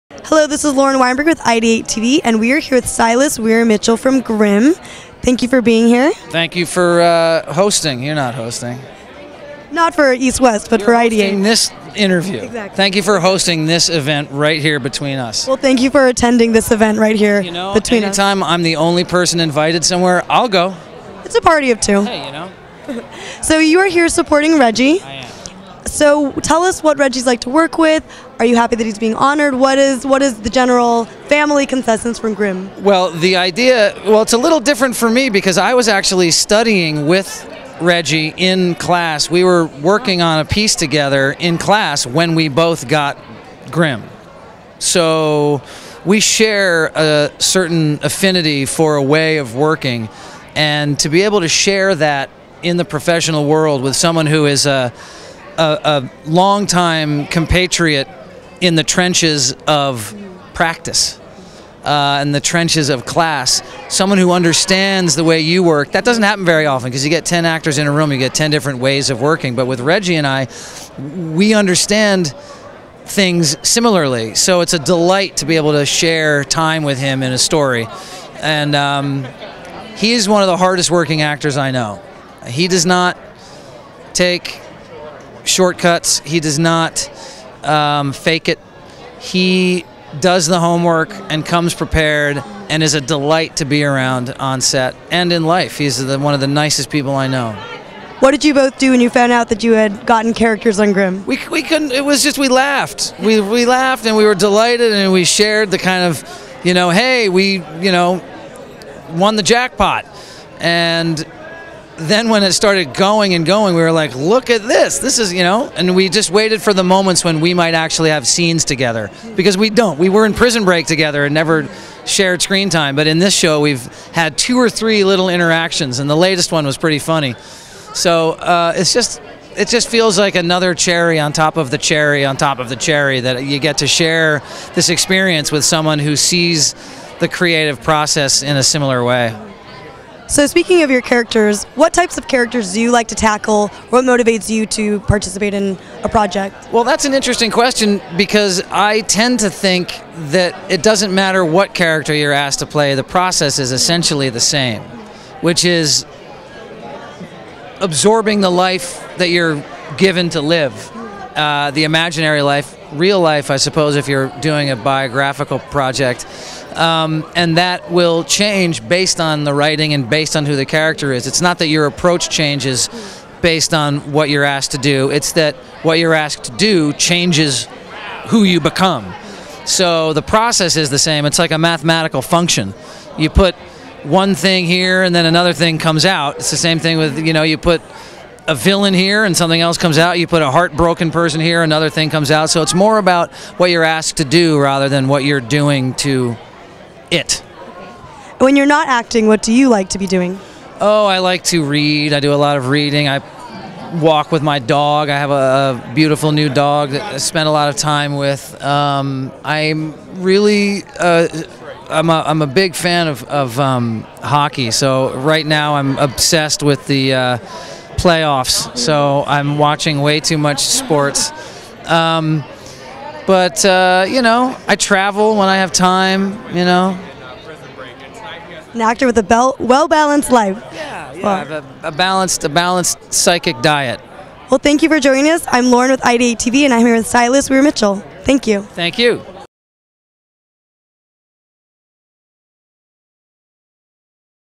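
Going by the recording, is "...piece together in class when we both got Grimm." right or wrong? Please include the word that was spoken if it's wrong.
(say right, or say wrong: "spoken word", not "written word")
right.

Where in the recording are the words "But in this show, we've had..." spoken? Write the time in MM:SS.
02:02.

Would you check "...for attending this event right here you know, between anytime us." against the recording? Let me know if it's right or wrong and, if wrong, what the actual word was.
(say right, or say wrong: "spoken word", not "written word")
right.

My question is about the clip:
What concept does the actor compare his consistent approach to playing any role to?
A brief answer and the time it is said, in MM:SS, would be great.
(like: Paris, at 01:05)
mathematical function, at 03:01.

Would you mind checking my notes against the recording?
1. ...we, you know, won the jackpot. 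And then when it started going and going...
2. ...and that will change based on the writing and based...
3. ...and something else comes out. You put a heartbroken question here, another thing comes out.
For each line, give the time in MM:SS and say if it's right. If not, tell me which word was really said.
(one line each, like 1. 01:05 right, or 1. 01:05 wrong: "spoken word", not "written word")
1. 01:47 right
2. 02:47 right
3. 03:09 wrong: "person", not "question".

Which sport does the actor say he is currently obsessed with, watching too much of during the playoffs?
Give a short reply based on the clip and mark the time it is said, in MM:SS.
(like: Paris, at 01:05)
hockey, at 03:34.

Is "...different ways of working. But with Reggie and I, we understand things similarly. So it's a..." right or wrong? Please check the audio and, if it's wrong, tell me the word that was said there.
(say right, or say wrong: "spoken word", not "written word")
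right.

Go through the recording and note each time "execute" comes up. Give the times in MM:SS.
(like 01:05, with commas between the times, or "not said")
not said.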